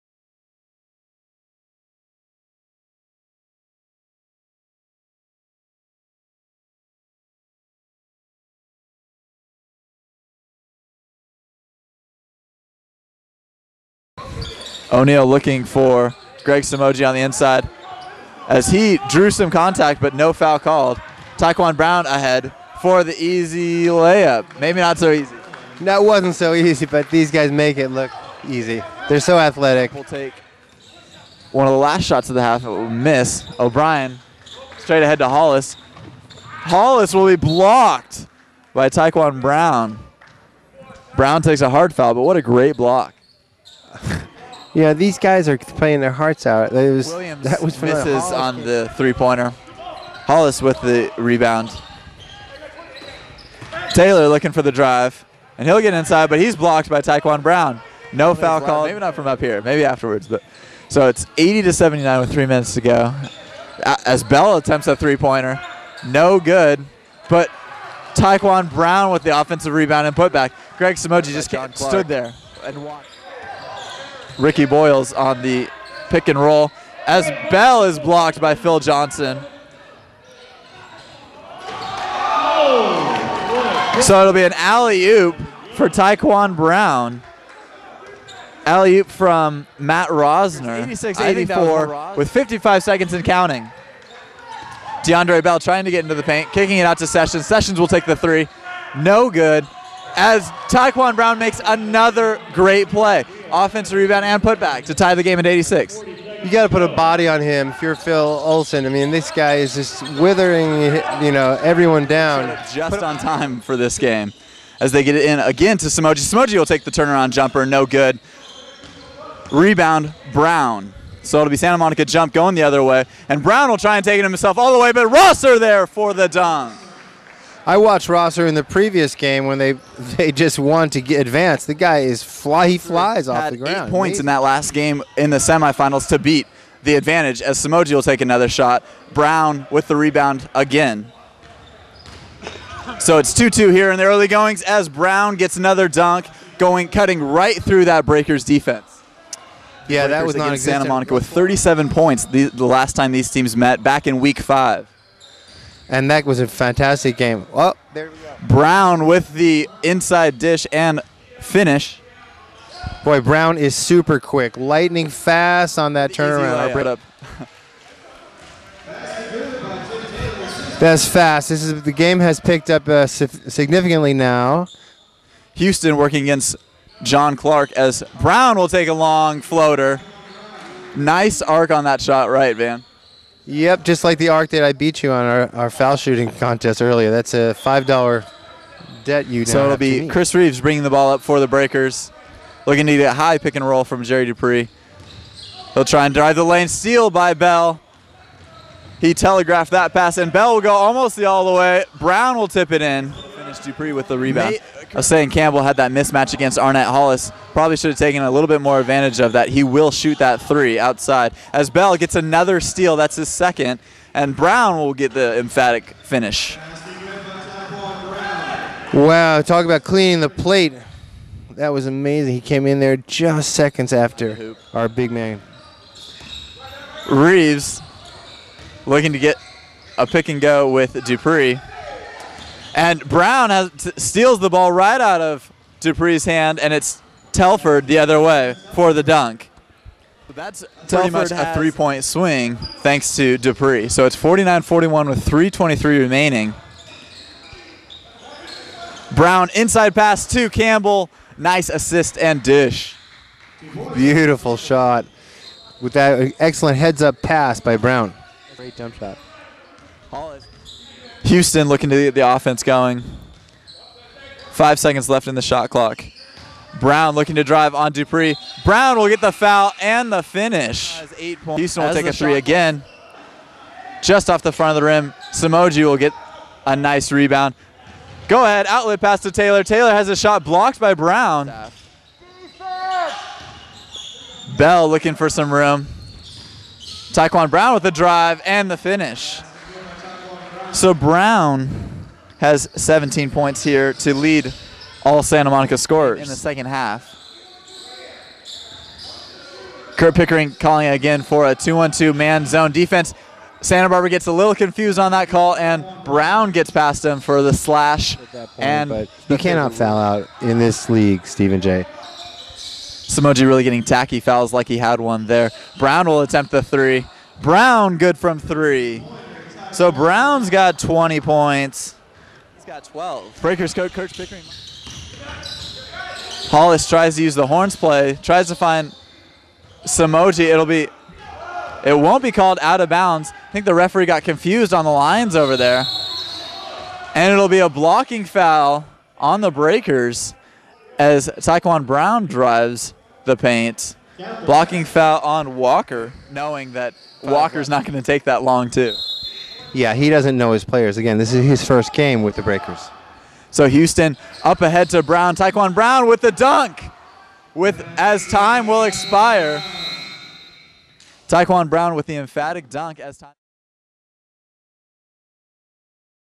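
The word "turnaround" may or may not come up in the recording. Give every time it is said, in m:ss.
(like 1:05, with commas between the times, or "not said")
1:56, 2:46.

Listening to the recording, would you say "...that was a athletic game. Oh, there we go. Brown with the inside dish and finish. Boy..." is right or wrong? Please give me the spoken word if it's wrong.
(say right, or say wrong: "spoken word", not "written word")
wrong: "fantastic", not "athletic".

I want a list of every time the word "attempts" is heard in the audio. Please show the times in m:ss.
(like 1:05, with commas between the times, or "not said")
1:04, 5:16.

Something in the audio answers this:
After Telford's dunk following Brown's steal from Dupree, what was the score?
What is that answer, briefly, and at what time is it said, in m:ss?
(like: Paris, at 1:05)
49-41, at 4:04.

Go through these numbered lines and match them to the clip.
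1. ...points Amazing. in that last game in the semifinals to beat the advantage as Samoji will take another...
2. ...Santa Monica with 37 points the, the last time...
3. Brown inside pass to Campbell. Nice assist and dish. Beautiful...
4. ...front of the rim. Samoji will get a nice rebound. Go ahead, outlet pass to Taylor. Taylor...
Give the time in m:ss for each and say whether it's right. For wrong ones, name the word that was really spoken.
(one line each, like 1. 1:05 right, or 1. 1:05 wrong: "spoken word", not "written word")
1. 2:13 right
2. 2:30 right
3. 4:09 right
4. 4:34 right.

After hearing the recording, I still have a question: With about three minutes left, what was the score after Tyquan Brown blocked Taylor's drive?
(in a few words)
80 to 79.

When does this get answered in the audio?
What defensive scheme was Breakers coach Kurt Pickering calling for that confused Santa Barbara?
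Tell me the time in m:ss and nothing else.
5:01.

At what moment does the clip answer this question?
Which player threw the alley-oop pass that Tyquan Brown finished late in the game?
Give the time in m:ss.
1:29.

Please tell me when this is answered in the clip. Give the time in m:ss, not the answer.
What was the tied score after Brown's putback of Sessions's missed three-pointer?
1:45.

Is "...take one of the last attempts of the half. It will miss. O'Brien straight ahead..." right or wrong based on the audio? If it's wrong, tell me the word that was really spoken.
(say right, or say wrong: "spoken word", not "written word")
wrong: "shots", not "attempts".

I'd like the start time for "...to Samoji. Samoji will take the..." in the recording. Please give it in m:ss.
1:55.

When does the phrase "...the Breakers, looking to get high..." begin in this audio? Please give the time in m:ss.
3:11.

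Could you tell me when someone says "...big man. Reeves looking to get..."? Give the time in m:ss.
3:44.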